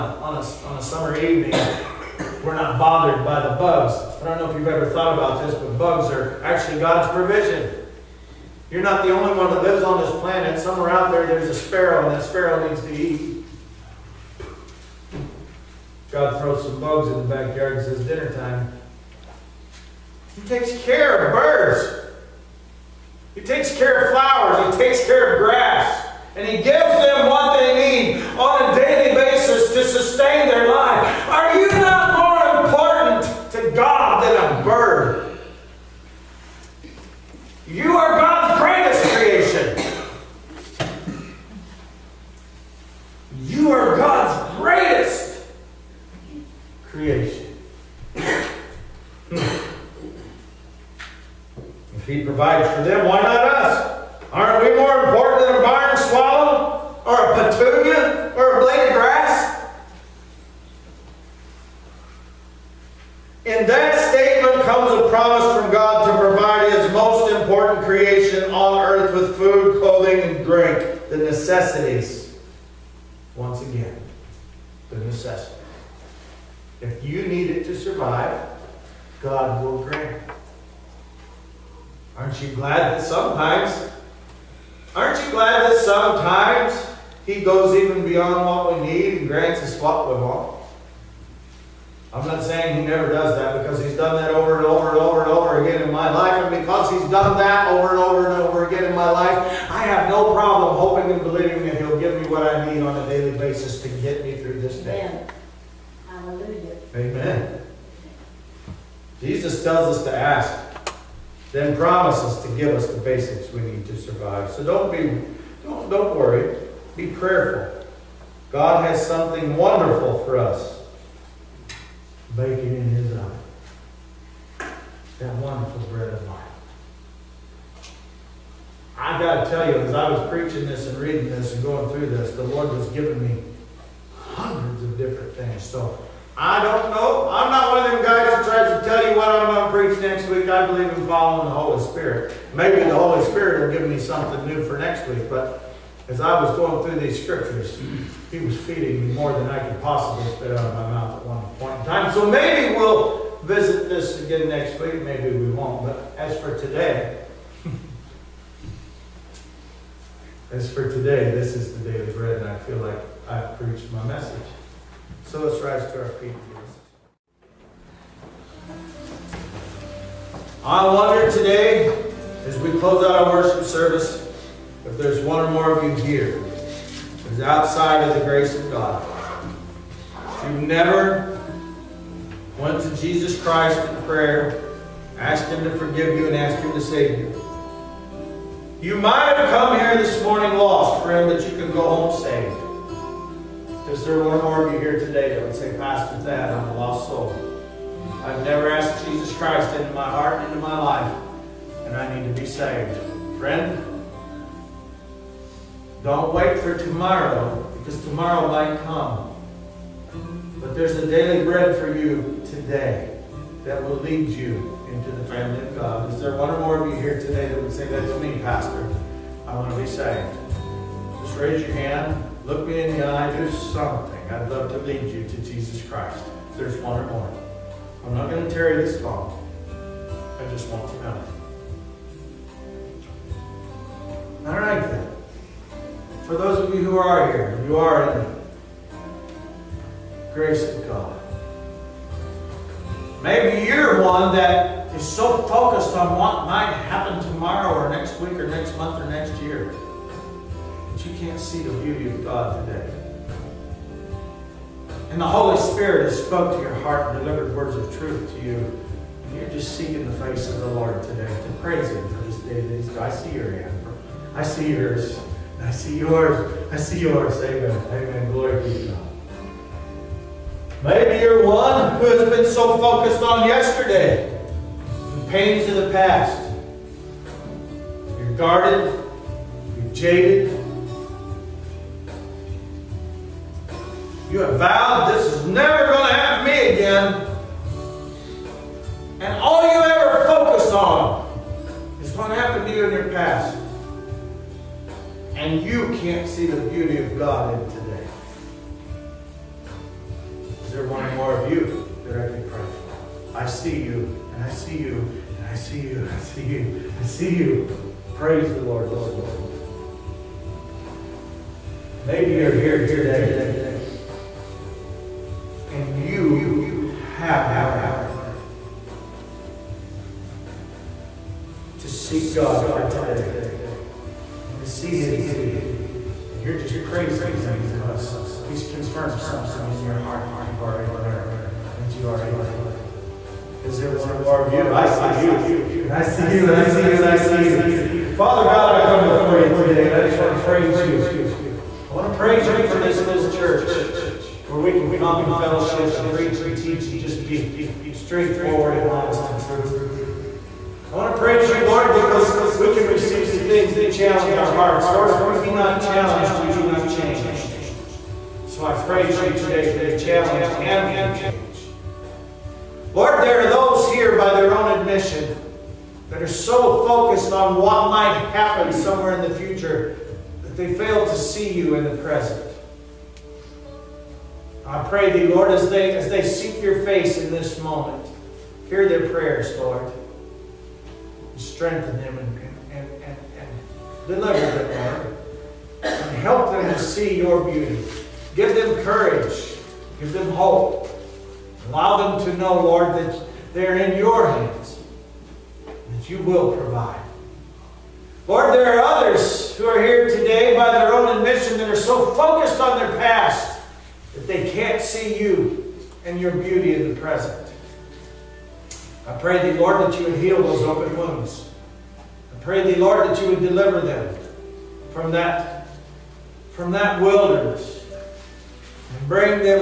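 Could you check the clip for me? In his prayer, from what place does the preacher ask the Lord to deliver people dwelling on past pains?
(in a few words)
wilderness.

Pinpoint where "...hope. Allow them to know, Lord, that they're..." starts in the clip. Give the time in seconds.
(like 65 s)
390 s.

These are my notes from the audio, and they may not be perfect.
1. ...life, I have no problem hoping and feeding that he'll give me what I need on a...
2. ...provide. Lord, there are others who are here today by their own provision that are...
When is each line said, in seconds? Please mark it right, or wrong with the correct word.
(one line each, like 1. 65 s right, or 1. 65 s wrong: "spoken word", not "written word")
1. 99 s wrong: "believing", not "feeding"
2. 396 s wrong: "admission", not "provision".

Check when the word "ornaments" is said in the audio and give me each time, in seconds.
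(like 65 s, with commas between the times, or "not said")
not said.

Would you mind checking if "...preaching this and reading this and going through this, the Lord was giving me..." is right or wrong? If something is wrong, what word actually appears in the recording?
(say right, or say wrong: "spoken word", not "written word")
right.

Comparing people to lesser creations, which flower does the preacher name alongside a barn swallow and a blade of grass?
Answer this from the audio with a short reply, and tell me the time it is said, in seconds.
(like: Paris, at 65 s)
petunia, at 57 s.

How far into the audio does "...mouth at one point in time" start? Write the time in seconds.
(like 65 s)
150 s.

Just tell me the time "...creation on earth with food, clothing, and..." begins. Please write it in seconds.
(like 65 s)
67 s.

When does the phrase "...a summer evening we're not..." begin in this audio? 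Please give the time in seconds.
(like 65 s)
0 s.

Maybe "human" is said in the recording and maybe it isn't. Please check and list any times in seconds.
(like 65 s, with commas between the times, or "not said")
not said.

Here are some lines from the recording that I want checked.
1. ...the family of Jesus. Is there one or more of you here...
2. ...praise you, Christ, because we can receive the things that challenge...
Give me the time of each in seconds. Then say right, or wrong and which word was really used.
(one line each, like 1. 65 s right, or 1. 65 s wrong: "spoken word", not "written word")
1. 215 s wrong: "God", not "Jesus"
2. 351 s wrong: "Lord", not "Christ".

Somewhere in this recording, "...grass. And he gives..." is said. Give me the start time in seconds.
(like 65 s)
25 s.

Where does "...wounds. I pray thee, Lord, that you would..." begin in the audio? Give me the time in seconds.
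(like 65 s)
410 s.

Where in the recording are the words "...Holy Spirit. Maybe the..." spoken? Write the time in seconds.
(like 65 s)
141 s.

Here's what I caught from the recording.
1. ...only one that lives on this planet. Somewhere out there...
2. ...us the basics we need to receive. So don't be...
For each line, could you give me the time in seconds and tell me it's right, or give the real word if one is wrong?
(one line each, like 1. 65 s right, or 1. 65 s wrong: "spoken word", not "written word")
1. 9 s right
2. 112 s wrong: "survive", not "receive".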